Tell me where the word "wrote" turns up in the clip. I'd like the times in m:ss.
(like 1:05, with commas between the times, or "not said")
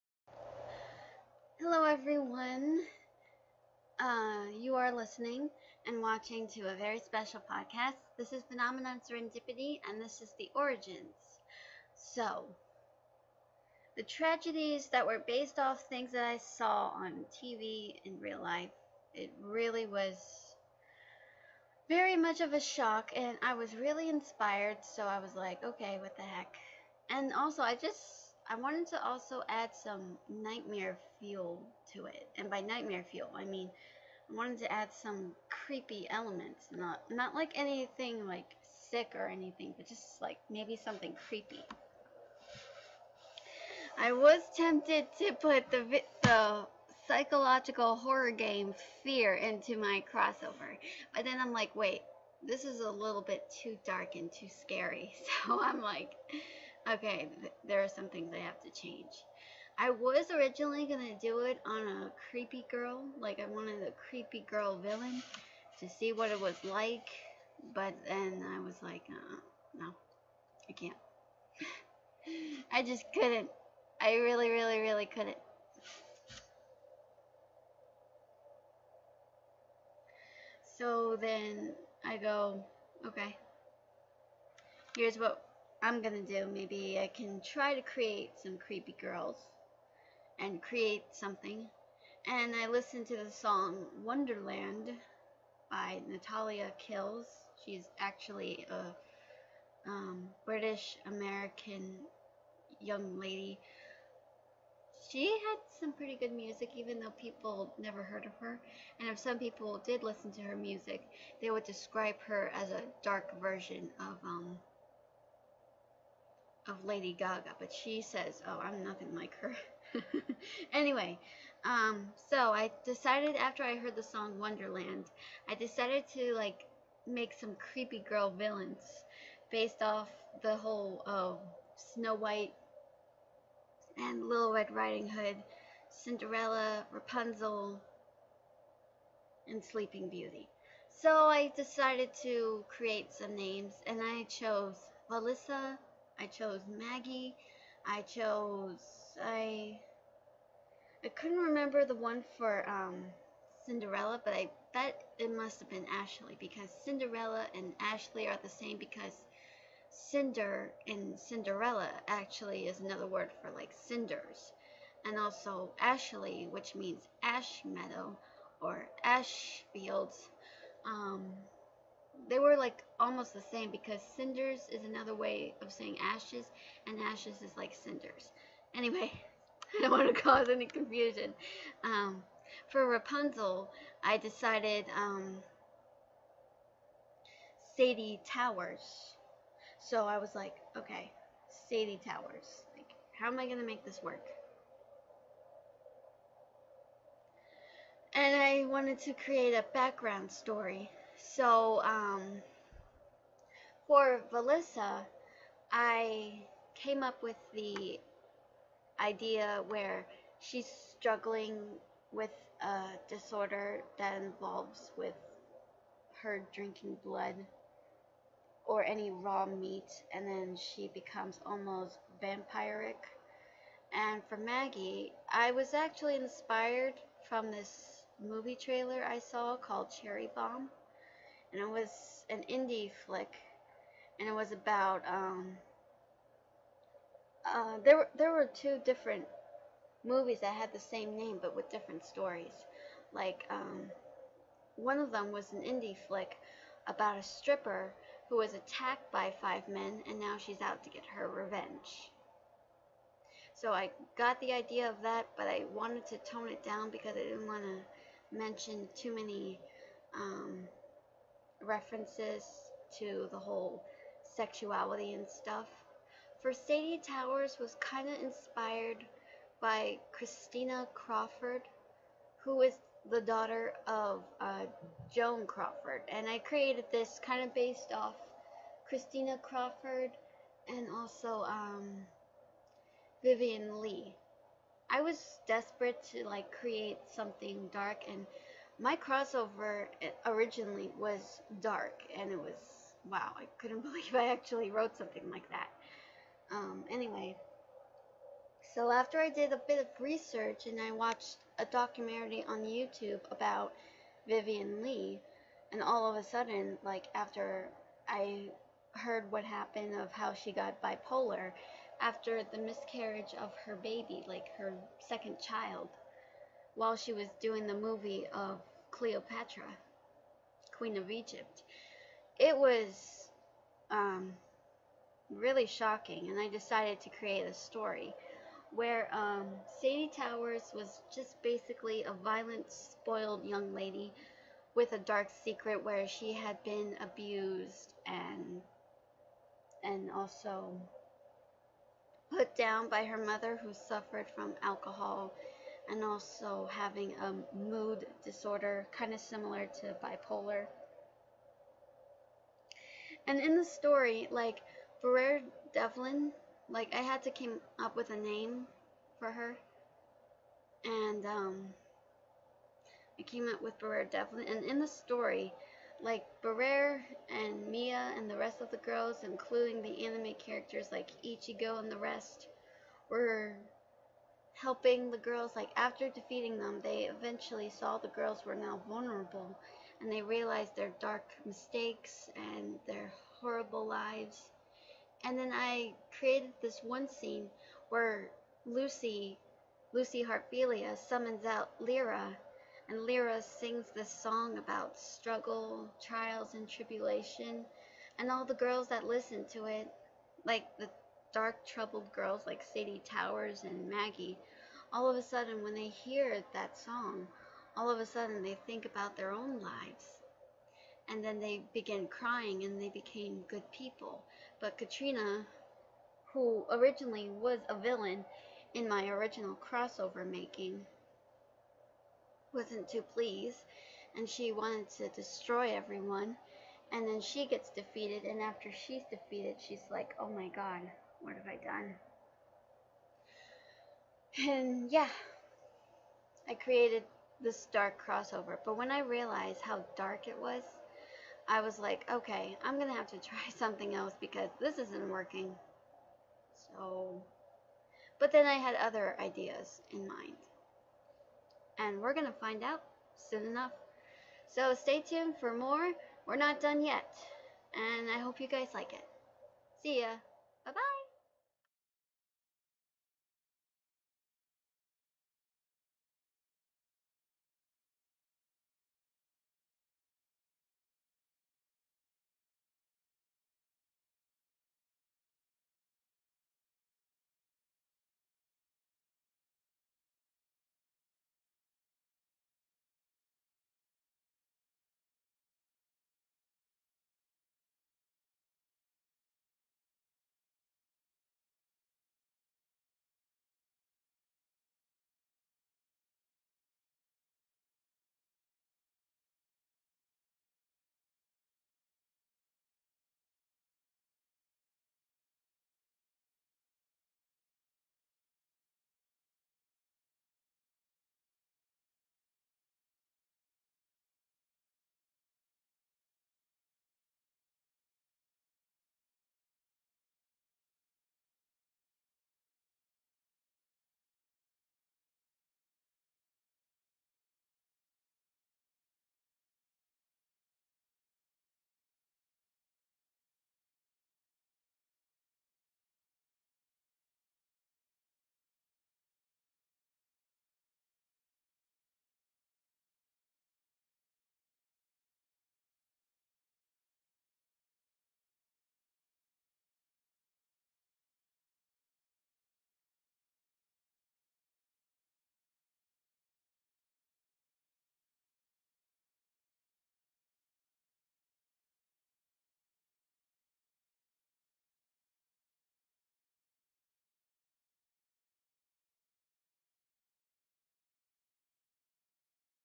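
4:54.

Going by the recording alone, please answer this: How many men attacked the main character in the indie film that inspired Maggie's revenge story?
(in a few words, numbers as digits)
5.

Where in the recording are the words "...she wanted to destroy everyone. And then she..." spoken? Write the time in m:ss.
7:04.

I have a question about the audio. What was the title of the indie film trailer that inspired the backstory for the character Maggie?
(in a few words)
Cherry Bomb.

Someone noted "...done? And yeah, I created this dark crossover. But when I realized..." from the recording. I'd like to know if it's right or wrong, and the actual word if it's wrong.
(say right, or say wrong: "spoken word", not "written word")
right.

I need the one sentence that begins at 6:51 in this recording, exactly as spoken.
And then they begin crying and they became good people.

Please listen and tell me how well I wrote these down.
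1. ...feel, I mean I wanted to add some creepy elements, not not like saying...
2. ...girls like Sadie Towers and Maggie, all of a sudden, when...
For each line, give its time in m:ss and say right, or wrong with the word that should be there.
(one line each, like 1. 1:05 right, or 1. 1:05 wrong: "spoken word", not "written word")
1. 0:33 wrong: "anything", not "saying"
2. 6:42 right.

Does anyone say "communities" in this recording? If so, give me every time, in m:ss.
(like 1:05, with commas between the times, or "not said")
not said.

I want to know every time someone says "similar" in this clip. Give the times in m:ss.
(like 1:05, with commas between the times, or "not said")
5:49.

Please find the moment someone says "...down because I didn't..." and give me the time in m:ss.
4:16.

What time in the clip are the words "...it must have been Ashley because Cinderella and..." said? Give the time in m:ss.
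2:35.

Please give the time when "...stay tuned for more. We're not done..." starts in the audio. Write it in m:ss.
7:34.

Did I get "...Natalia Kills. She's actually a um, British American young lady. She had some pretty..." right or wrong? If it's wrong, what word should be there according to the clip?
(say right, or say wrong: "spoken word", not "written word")
right.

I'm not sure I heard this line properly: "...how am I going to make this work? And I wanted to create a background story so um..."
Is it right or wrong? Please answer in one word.
right.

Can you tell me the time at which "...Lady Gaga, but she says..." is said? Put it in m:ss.
1:56.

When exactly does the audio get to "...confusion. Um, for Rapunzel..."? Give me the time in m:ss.
3:00.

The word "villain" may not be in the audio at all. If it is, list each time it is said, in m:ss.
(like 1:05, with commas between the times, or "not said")
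1:04, 2:08, 6:57.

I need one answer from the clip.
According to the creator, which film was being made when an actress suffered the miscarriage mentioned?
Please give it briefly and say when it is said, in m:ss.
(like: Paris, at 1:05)
Cleopatra, at 5:18.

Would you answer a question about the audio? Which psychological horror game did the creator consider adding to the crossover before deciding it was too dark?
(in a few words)
Fear.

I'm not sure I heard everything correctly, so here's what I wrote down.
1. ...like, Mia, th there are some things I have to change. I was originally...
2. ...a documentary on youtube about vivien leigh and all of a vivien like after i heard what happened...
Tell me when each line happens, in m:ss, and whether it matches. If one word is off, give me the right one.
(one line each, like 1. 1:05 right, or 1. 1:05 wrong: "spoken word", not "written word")
1. 0:55 wrong: "Okay", not "Mia"
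2. 5:01 wrong: "sudden", not "vivien".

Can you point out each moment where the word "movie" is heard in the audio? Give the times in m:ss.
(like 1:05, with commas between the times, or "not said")
3:48, 4:00, 5:17.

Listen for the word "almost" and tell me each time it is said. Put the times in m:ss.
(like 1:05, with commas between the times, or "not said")
2:52, 3:41.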